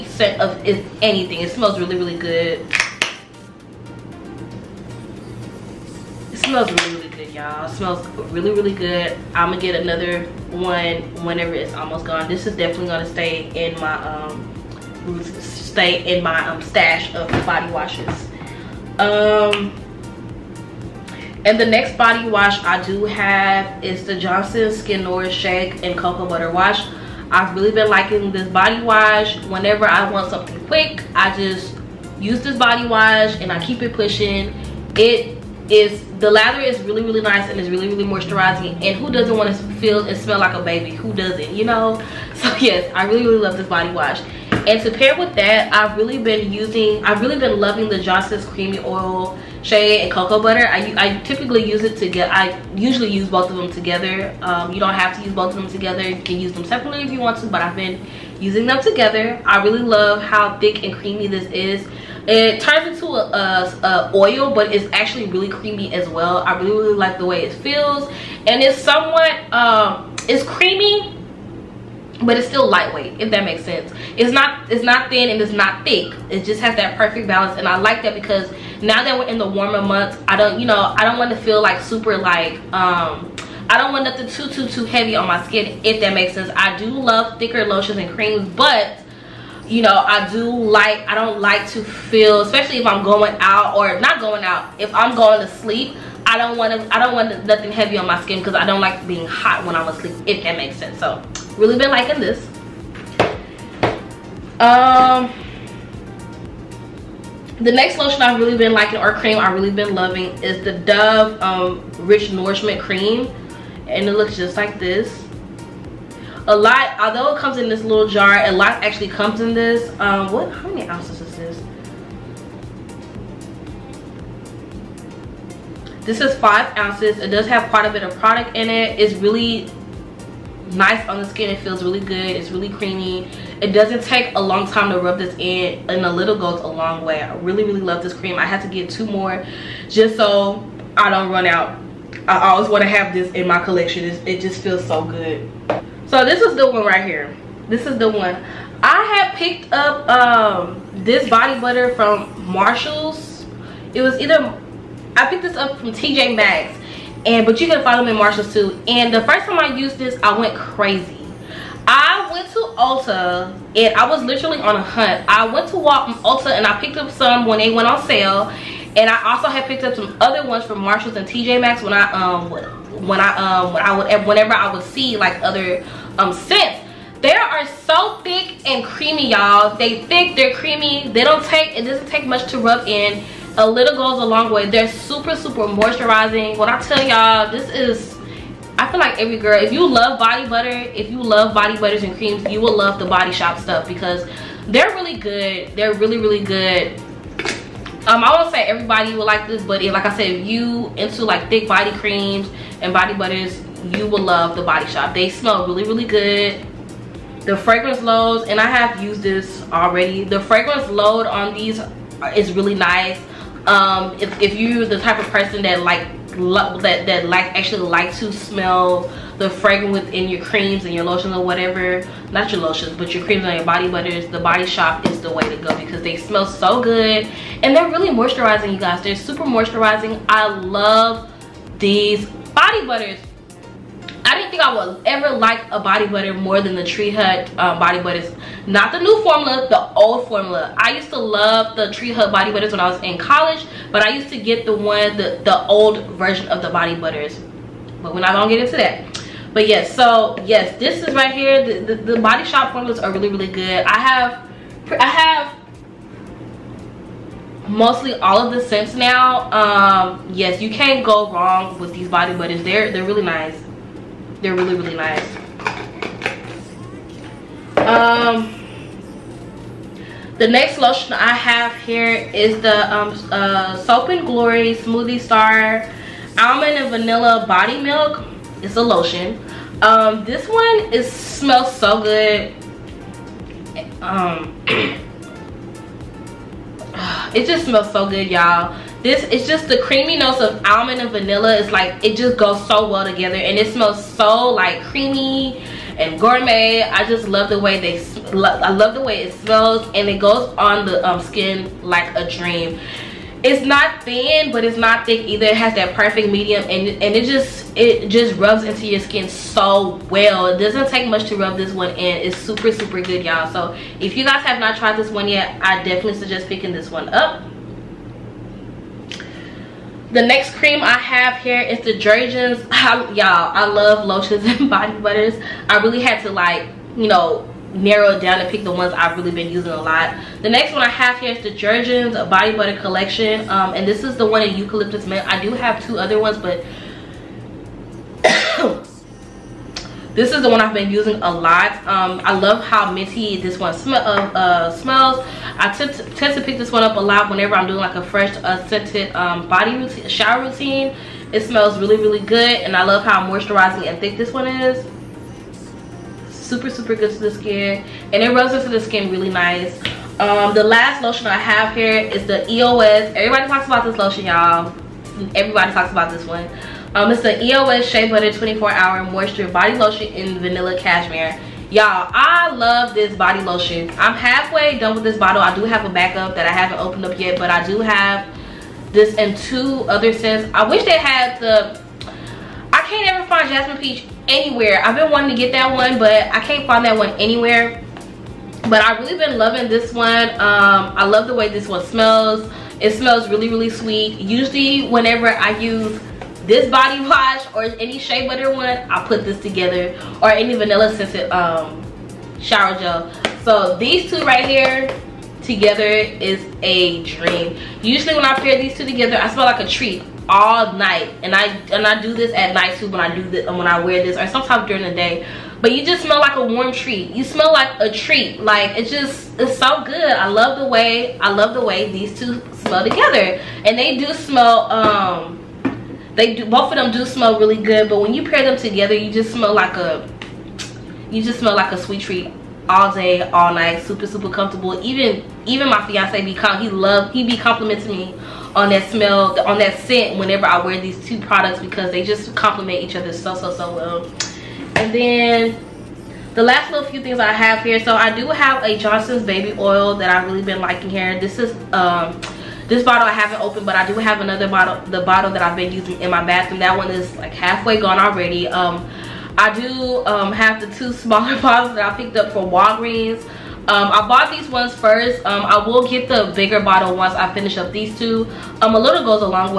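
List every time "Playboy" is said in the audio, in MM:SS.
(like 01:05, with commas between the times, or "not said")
not said.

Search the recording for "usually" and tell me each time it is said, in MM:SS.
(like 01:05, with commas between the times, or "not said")
00:52, 06:34, 06:47.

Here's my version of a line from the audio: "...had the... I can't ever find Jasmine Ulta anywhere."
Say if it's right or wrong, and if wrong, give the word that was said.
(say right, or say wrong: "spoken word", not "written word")
wrong: "Peach", not "Ulta".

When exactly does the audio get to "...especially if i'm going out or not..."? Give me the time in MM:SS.
01:32.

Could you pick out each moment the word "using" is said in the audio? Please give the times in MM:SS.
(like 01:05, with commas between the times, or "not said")
00:46, 00:58, 05:29, 05:40, 07:35.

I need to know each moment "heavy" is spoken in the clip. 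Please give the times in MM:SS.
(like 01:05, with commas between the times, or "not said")
01:24, 01:37.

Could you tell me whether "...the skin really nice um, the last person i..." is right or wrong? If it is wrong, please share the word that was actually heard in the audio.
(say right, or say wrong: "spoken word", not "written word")
wrong: "lotion", not "person".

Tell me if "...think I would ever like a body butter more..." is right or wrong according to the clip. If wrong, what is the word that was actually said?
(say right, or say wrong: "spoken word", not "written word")
right.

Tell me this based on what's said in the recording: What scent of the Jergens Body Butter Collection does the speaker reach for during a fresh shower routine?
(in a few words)
eucalyptus mint.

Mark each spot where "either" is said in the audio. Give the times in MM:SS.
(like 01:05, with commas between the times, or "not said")
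02:34, 05:05.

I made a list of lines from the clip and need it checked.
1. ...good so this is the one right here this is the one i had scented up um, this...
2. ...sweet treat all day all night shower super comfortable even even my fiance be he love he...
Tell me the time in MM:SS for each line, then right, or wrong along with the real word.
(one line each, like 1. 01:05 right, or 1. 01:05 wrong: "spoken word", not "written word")
1. 02:25 wrong: "picked", not "scented"
2. 07:11 wrong: "super", not "shower".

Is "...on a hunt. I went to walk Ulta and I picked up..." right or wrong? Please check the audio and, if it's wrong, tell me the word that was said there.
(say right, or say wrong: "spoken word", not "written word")
right.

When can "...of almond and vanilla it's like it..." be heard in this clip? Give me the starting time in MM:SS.
04:50.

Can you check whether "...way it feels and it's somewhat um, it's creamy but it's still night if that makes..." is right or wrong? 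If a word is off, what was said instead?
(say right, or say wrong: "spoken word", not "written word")
wrong: "lightweight", not "night".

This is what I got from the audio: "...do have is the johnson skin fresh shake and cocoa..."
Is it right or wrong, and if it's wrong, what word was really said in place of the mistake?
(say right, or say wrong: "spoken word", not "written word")
wrong: "nourish", not "fresh".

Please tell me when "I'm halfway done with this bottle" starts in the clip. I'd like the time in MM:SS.
06:13.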